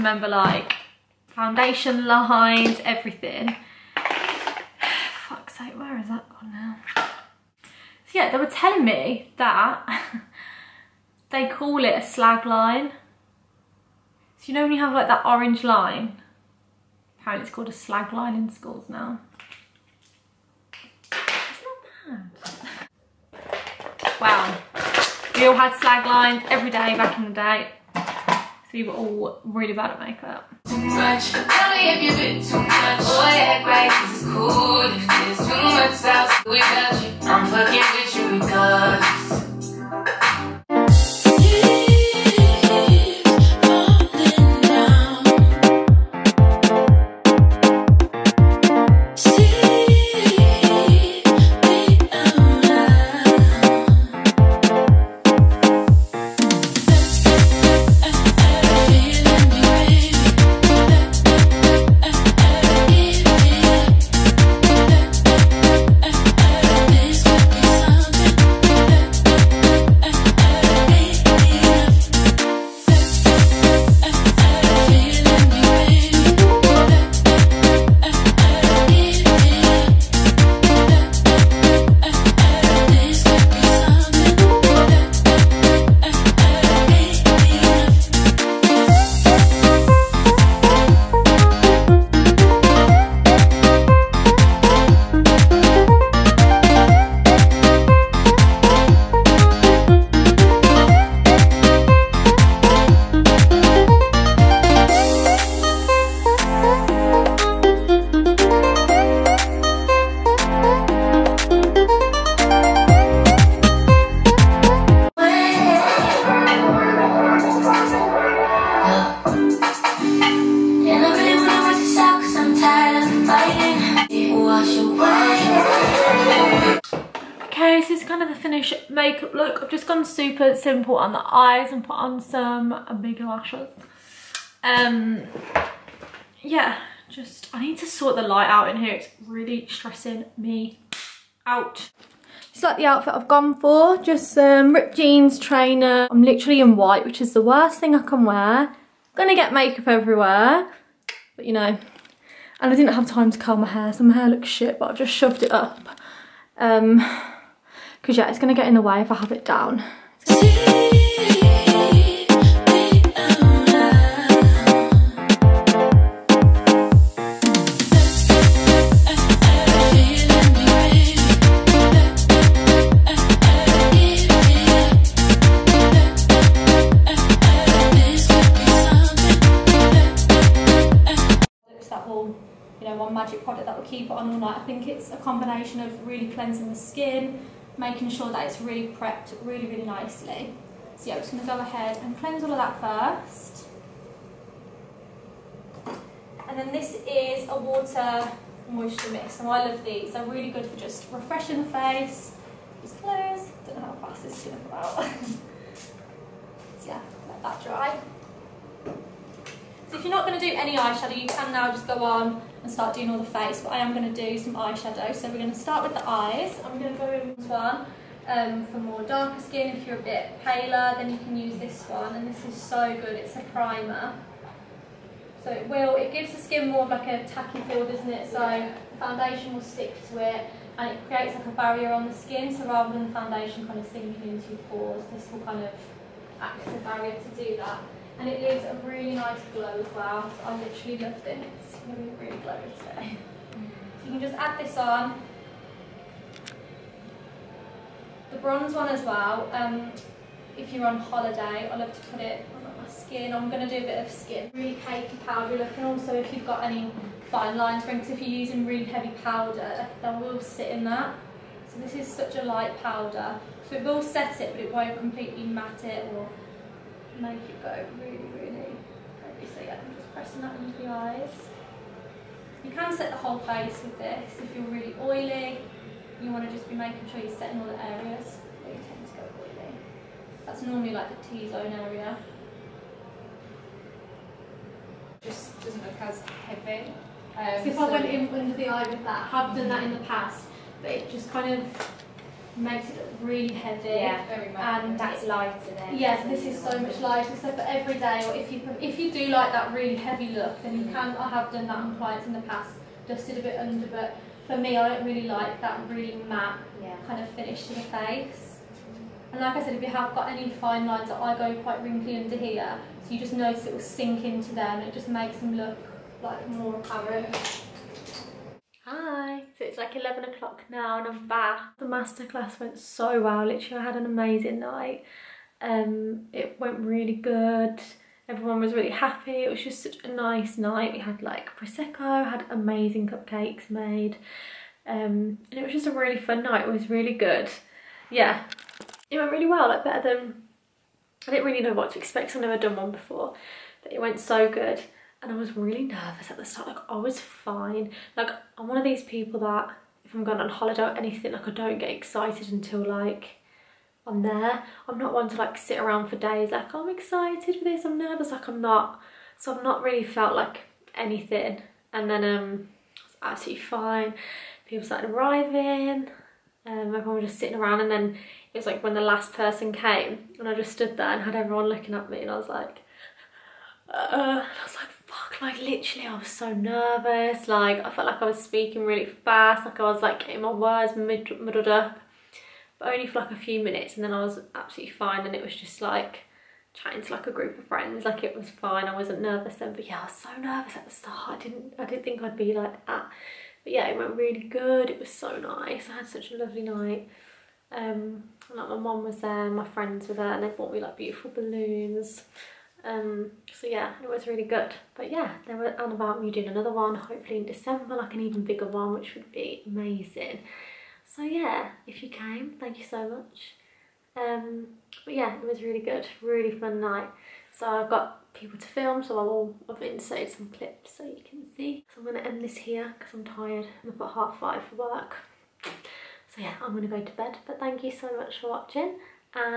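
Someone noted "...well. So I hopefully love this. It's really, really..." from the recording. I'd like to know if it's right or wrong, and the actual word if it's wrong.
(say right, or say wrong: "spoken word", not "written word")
wrong: "literally", not "hopefully".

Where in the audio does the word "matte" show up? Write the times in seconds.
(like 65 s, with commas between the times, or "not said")
265 s, 306 s.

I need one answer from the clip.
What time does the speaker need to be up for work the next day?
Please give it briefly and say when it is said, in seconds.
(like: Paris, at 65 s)
half five, at 424 s.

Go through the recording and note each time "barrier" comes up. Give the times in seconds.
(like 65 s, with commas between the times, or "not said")
231 s, 236 s.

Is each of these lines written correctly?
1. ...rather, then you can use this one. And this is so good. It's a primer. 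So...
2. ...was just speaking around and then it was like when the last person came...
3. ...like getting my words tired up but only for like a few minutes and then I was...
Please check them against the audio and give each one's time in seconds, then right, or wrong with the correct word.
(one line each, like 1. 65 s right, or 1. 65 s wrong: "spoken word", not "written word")
1. 220 s wrong: "paler", not "rather"
2. 367 s wrong: "sitting", not "speaking"
3. 380 s wrong: "muddled", not "tired".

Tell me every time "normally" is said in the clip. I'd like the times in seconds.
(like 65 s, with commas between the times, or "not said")
280 s.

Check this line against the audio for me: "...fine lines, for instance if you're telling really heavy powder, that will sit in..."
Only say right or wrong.
wrong.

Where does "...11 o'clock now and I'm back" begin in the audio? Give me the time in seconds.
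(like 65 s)
319 s.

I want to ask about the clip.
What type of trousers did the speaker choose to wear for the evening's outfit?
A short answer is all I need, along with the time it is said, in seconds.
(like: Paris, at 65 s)
ripped jeans, at 144 s.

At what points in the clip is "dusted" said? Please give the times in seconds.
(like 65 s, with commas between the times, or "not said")
303 s.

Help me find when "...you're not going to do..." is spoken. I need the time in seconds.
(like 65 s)
210 s.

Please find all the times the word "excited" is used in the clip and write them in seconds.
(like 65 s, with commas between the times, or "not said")
351 s, 356 s.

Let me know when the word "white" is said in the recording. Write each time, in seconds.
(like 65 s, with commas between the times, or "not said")
146 s.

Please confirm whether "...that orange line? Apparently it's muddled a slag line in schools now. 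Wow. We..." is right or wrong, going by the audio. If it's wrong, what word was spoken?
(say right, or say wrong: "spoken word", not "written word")
wrong: "called", not "muddled".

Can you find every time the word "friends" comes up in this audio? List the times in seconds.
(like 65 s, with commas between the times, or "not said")
387 s, 399 s.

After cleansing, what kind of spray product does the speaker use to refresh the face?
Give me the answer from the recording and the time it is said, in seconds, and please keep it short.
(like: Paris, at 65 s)
water moisture mix, at 197 s.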